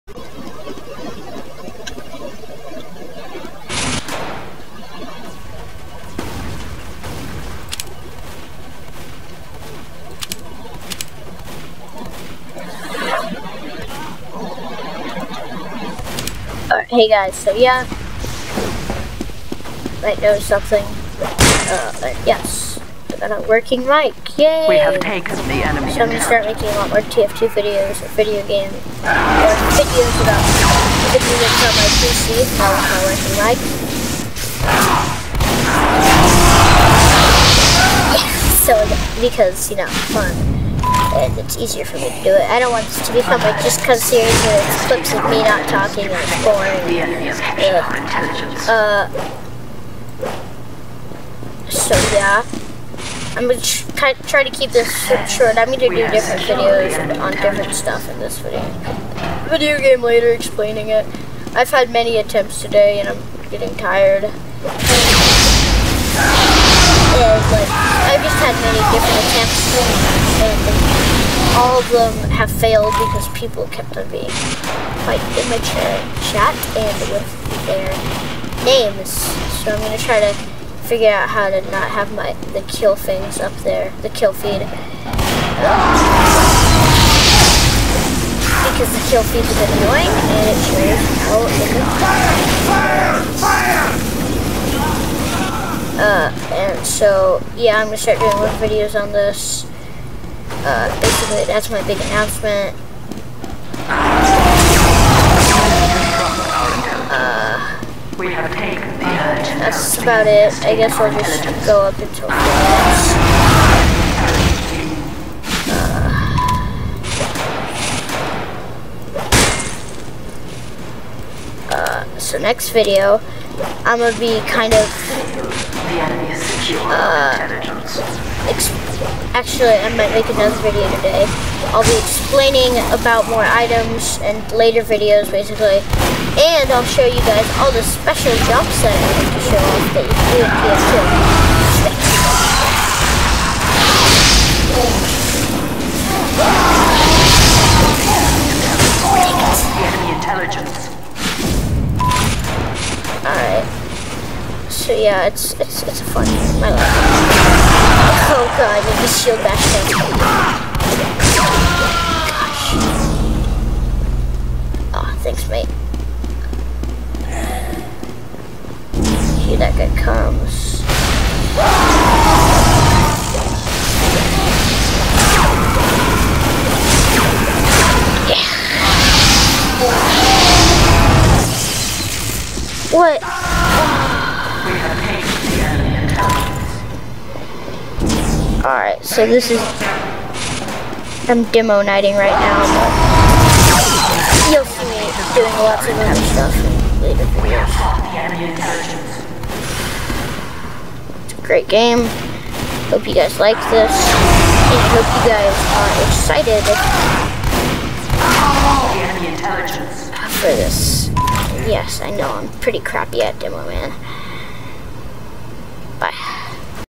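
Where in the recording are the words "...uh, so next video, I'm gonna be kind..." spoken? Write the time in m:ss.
2:01.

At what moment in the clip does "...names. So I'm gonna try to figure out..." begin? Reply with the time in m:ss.
1:18.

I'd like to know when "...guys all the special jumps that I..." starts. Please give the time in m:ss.
2:17.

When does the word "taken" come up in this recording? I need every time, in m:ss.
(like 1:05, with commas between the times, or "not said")
0:24, 1:48.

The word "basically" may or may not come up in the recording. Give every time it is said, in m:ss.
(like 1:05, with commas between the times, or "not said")
1:41, 2:15.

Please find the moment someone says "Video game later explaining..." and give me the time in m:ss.
0:59.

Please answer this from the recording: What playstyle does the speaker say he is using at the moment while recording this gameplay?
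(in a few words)
demoknighting.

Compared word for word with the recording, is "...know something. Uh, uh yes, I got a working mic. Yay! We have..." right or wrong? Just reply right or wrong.
right.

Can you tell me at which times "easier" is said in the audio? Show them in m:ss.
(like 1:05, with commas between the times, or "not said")
0:41.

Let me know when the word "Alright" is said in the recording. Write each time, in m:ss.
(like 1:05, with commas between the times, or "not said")
2:33, 3:08.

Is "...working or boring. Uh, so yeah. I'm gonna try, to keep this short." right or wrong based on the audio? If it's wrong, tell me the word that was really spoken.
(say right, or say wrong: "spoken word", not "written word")
wrong: "talking", not "working".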